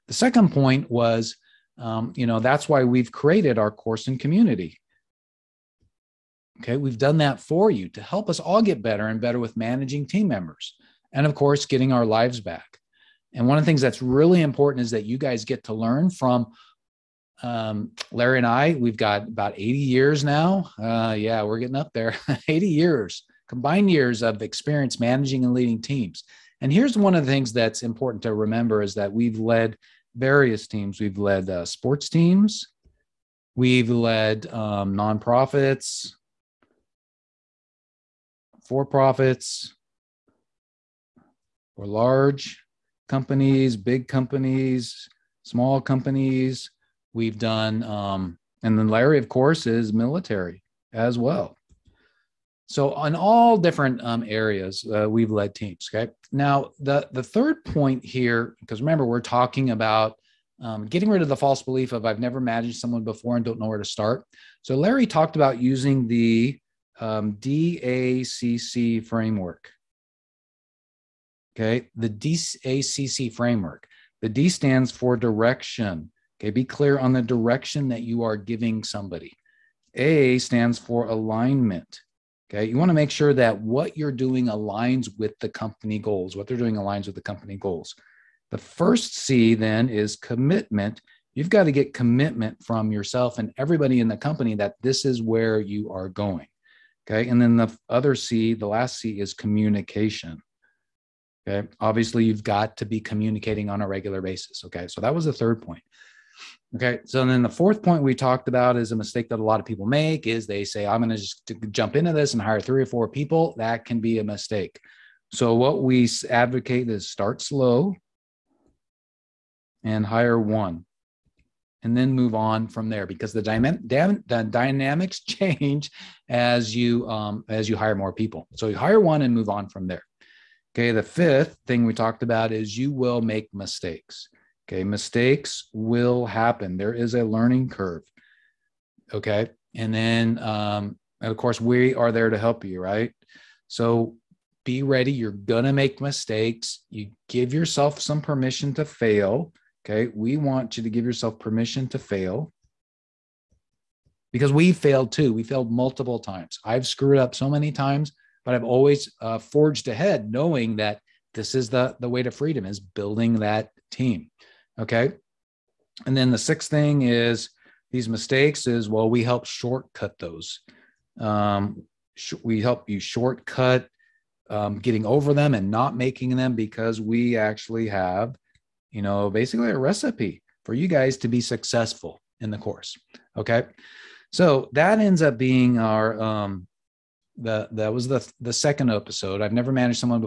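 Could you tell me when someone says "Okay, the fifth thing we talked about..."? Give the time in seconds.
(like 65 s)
130 s.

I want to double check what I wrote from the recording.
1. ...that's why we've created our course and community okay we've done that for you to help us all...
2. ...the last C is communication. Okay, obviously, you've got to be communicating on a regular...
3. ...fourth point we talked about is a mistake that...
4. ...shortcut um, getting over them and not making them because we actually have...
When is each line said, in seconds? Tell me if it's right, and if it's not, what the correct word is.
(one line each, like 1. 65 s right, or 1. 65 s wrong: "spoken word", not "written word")
1. 2 s right
2. 98 s right
3. 107 s right
4. 172 s right.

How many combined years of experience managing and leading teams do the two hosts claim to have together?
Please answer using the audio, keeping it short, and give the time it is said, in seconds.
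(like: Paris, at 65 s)
80, at 22 s.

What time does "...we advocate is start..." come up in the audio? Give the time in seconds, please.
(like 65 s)
115 s.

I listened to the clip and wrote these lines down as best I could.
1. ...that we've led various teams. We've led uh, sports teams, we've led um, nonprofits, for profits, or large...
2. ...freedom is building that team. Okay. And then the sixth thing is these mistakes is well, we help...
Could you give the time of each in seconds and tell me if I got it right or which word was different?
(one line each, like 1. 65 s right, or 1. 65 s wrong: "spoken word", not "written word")
1. 28 s right
2. 162 s right.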